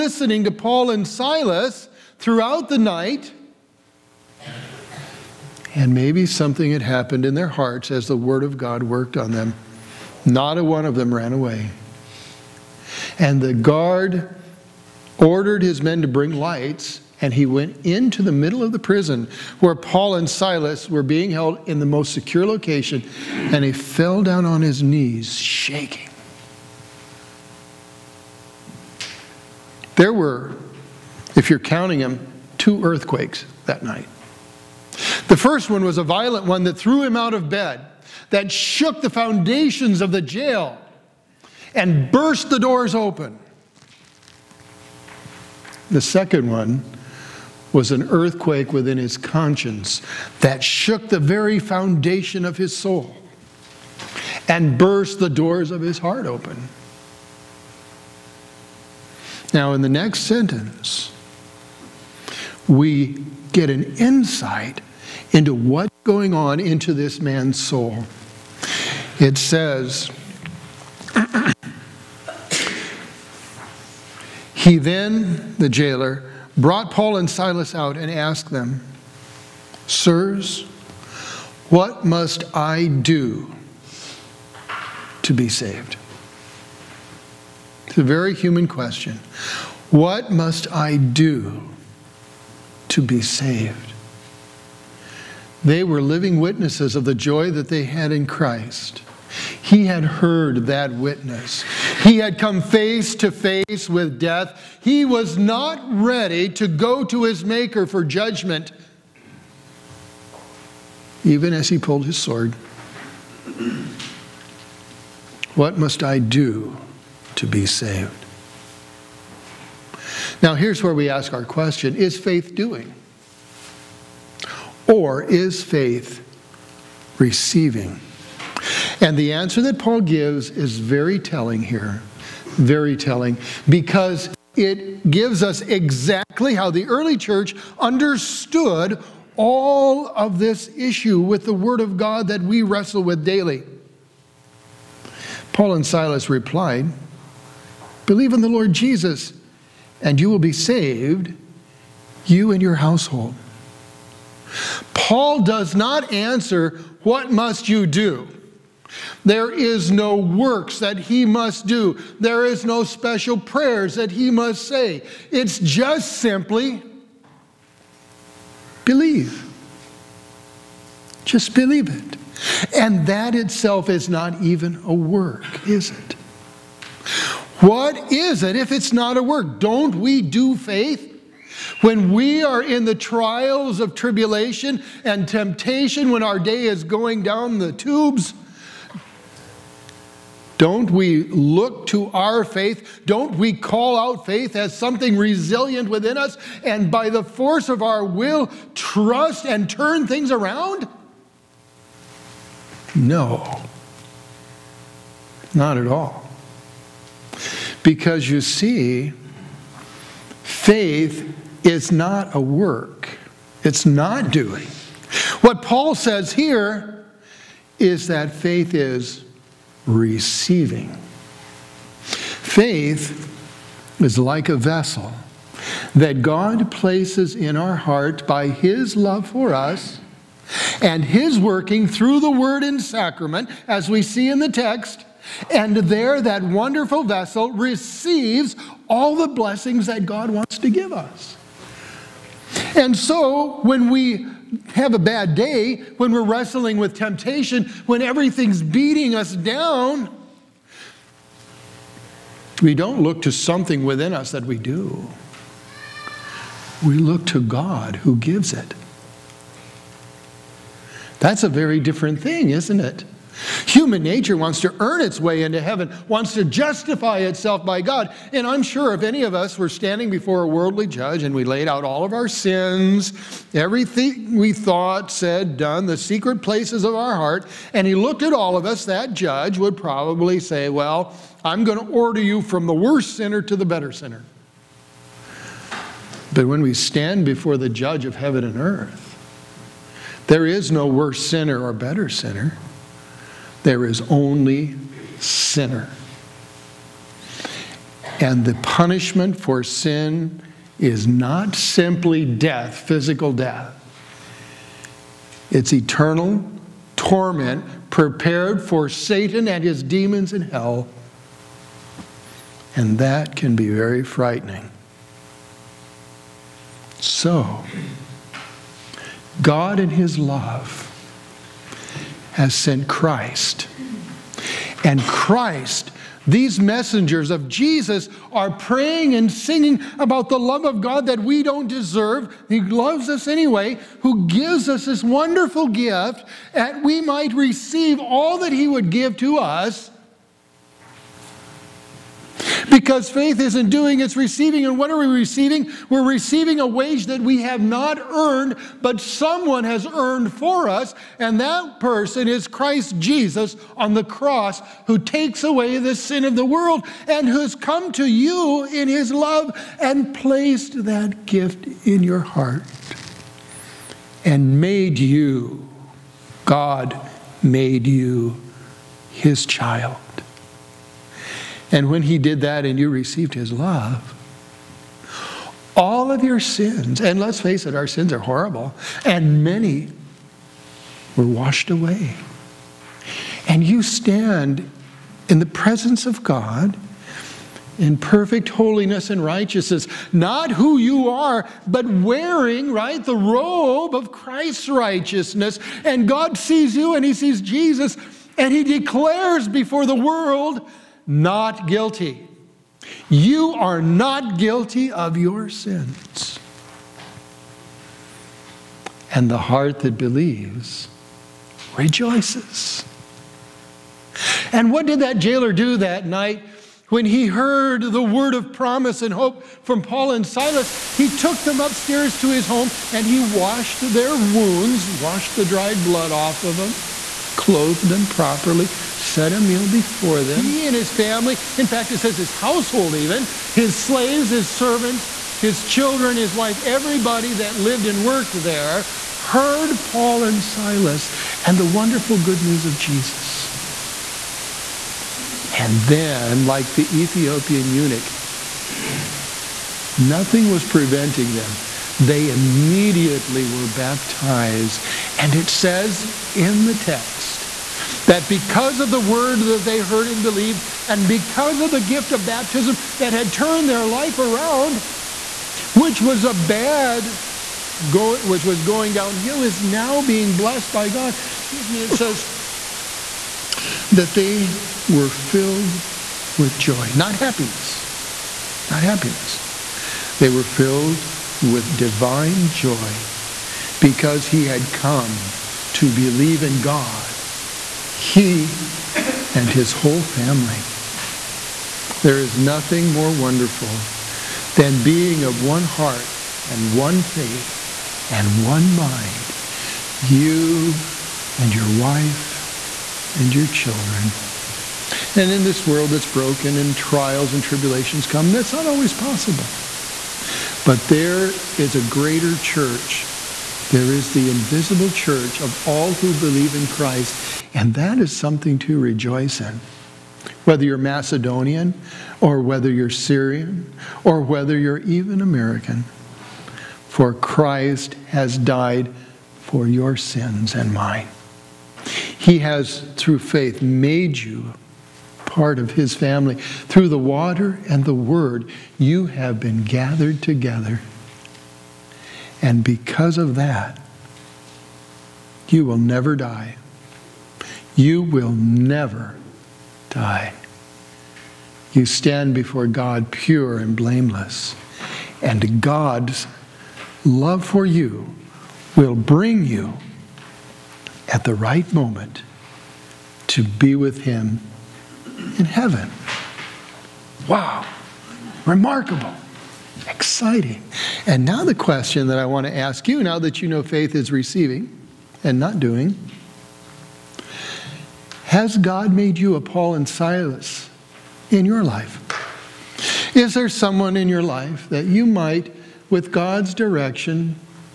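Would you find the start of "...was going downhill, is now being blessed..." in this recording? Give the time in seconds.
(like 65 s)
468 s.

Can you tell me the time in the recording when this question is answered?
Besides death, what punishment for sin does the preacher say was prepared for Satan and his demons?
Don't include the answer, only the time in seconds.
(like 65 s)
305 s.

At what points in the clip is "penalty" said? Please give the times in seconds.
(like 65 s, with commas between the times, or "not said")
not said.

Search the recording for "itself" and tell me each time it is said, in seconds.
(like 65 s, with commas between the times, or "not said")
173 s, 267 s.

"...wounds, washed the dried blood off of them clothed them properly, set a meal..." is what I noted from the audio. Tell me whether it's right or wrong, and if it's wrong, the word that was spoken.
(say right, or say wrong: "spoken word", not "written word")
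right.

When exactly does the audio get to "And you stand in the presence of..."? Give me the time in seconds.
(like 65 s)
383 s.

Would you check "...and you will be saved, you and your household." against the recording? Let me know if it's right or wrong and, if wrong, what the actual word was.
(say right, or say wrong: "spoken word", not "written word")
right.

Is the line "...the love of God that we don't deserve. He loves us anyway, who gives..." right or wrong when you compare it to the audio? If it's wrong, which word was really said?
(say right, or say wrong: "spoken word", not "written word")
right.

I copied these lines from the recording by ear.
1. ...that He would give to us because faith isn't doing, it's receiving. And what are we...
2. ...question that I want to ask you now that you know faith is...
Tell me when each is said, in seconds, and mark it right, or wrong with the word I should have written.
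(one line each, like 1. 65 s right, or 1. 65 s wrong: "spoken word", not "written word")
1. 338 s right
2. 571 s right.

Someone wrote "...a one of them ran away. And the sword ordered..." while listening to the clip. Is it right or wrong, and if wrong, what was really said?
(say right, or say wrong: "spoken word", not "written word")
wrong: "guard", not "sword".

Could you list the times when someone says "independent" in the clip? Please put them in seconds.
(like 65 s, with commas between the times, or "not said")
not said.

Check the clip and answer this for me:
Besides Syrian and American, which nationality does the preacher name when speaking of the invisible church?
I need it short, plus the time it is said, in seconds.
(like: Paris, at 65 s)
Macedonian, at 520 s.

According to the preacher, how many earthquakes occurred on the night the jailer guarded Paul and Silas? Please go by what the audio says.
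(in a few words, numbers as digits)
2.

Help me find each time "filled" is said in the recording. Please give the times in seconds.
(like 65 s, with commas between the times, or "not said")
475 s, 480 s.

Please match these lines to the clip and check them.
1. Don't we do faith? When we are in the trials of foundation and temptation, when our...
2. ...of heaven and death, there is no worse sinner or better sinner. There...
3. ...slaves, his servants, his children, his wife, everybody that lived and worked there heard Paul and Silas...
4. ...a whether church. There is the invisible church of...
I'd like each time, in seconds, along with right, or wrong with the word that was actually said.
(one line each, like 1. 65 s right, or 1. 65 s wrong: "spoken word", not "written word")
1. 179 s wrong: "tribulation", not "foundation"
2. 288 s wrong: "earth", not "death"
3. 433 s right
4. 511 s wrong: "greater", not "whether".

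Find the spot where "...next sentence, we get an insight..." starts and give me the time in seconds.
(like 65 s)
59 s.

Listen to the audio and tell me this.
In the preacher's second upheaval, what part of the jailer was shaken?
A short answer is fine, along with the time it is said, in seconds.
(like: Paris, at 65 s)
his conscience, at 48 s.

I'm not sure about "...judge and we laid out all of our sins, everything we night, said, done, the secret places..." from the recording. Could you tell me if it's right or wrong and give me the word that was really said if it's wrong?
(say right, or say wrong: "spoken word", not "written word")
wrong: "thought", not "night".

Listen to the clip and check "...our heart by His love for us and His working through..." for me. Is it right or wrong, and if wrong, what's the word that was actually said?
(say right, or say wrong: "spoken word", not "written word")
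right.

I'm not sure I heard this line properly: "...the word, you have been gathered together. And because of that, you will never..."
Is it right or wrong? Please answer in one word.
right.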